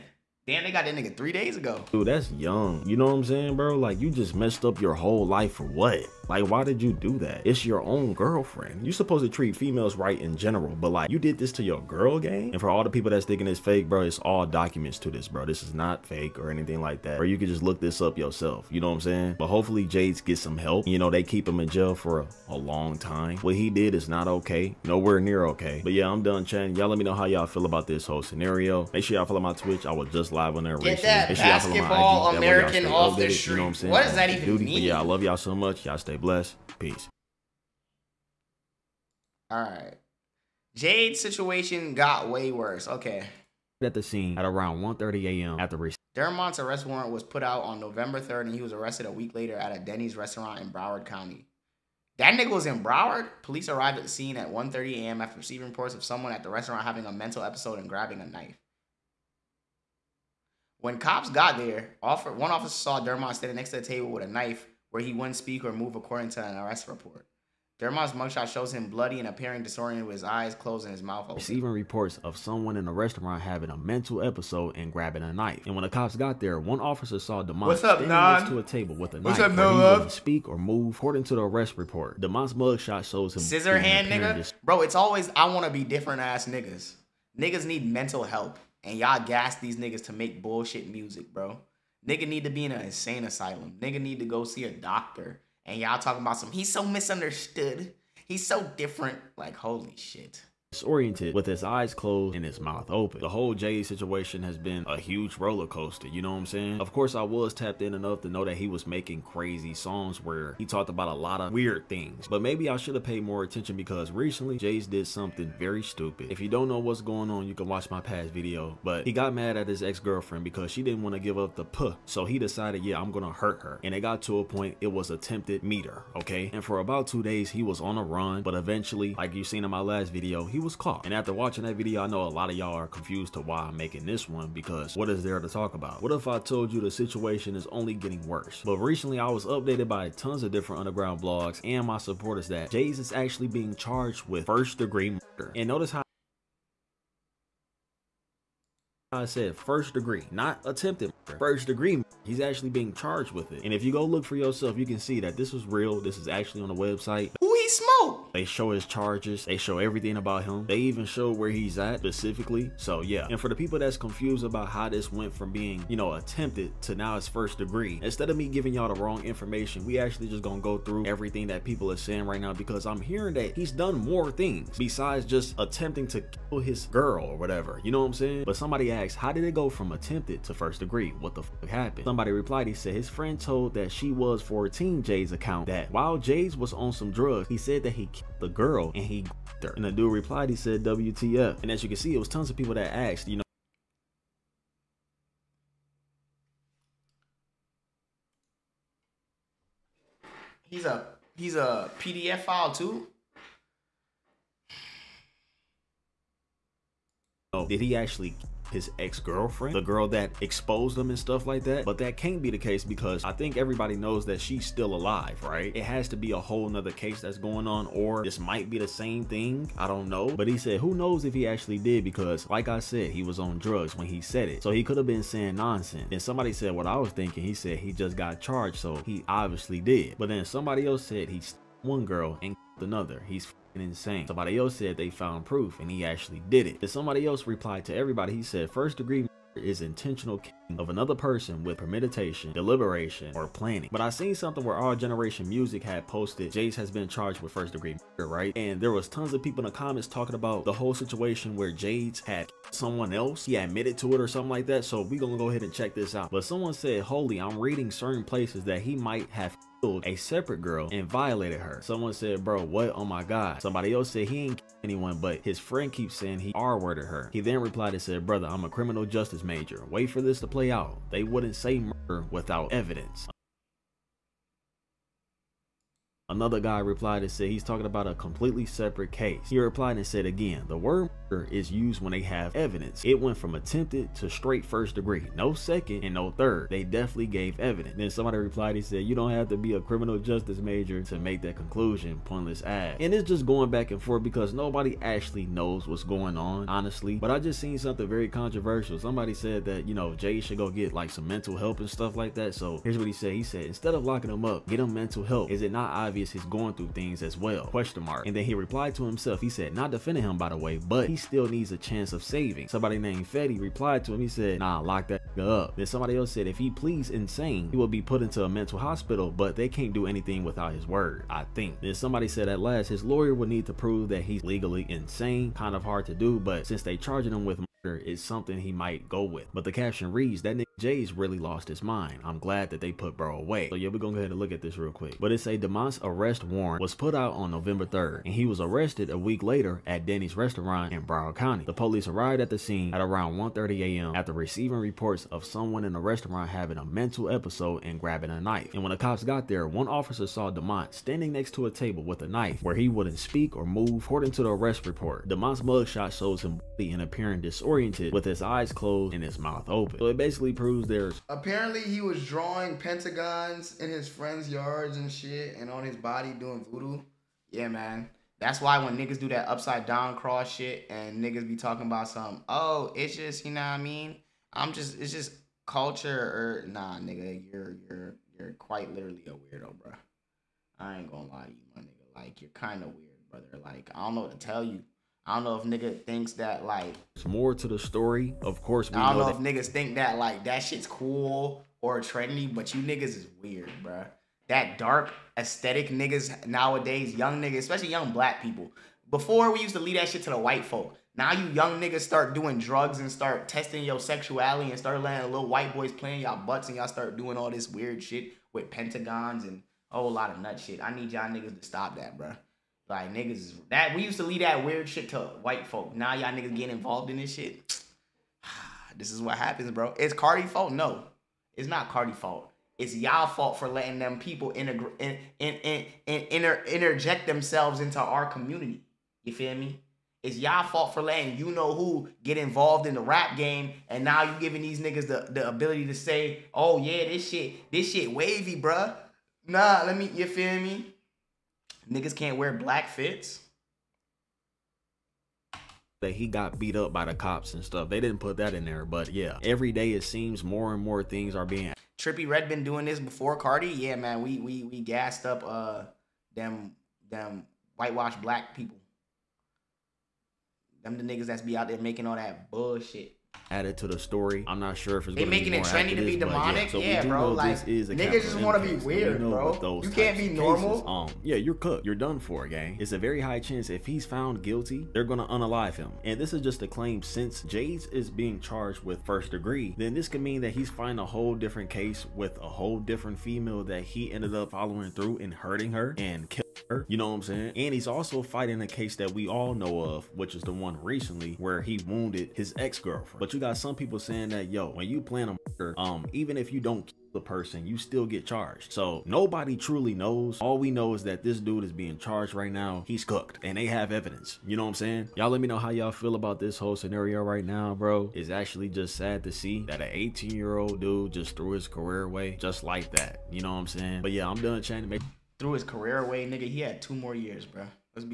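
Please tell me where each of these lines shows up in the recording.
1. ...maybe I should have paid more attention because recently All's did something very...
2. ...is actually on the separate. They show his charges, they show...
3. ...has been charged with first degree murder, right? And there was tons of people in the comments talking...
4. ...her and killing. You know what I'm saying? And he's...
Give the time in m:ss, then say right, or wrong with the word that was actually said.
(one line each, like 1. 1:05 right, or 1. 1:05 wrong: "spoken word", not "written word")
1. 1:52 wrong: "Jay", not "All"
2. 2:36 wrong: "website", not "separate"
3. 4:06 right
4. 8:05 right.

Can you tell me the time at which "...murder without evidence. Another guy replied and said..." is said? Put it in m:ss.
4:31.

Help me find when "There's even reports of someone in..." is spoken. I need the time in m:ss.
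1:11.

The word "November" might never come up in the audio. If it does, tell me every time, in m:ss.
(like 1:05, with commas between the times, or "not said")
0:47, 5:37.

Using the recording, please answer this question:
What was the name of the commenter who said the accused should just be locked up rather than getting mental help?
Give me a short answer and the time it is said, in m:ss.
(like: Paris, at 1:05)
Fetty, at 5:13.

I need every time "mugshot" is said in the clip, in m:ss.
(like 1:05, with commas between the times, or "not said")
1:08, 1:22, 5:55.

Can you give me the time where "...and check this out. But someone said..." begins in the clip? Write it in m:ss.
4:15.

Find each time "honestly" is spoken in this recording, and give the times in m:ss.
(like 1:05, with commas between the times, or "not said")
4:56.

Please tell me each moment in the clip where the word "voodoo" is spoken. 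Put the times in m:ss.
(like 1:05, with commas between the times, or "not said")
6:06.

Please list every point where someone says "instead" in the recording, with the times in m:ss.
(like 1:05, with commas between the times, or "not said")
2:48, 5:03.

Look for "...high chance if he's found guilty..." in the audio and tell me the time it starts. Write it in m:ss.
7:53.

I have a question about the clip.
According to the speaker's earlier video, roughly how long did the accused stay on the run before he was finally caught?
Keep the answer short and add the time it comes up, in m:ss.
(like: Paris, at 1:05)
2 days, at 2:07.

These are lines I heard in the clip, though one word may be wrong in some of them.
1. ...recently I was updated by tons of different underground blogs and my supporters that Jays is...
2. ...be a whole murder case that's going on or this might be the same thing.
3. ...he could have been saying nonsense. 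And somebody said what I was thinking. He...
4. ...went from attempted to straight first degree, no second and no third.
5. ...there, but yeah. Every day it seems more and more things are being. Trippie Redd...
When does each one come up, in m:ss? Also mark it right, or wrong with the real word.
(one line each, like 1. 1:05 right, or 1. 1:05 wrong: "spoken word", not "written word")
1. 2:18 right
2. 3:36 wrong: "nother", not "murder"
3. 3:44 right
4. 4:43 right
5. 7:28 right.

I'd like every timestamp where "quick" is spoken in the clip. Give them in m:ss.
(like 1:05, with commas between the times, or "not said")
5:34.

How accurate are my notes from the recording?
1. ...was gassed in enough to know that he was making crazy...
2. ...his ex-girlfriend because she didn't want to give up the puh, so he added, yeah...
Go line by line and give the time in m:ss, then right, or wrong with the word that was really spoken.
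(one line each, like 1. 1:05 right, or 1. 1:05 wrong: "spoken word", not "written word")
1. 1:47 wrong: "tapped", not "gassed"
2. 1:59 wrong: "decided", not "added".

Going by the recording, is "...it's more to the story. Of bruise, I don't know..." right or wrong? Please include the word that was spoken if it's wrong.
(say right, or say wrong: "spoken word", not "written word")
wrong: "course", not "bruise".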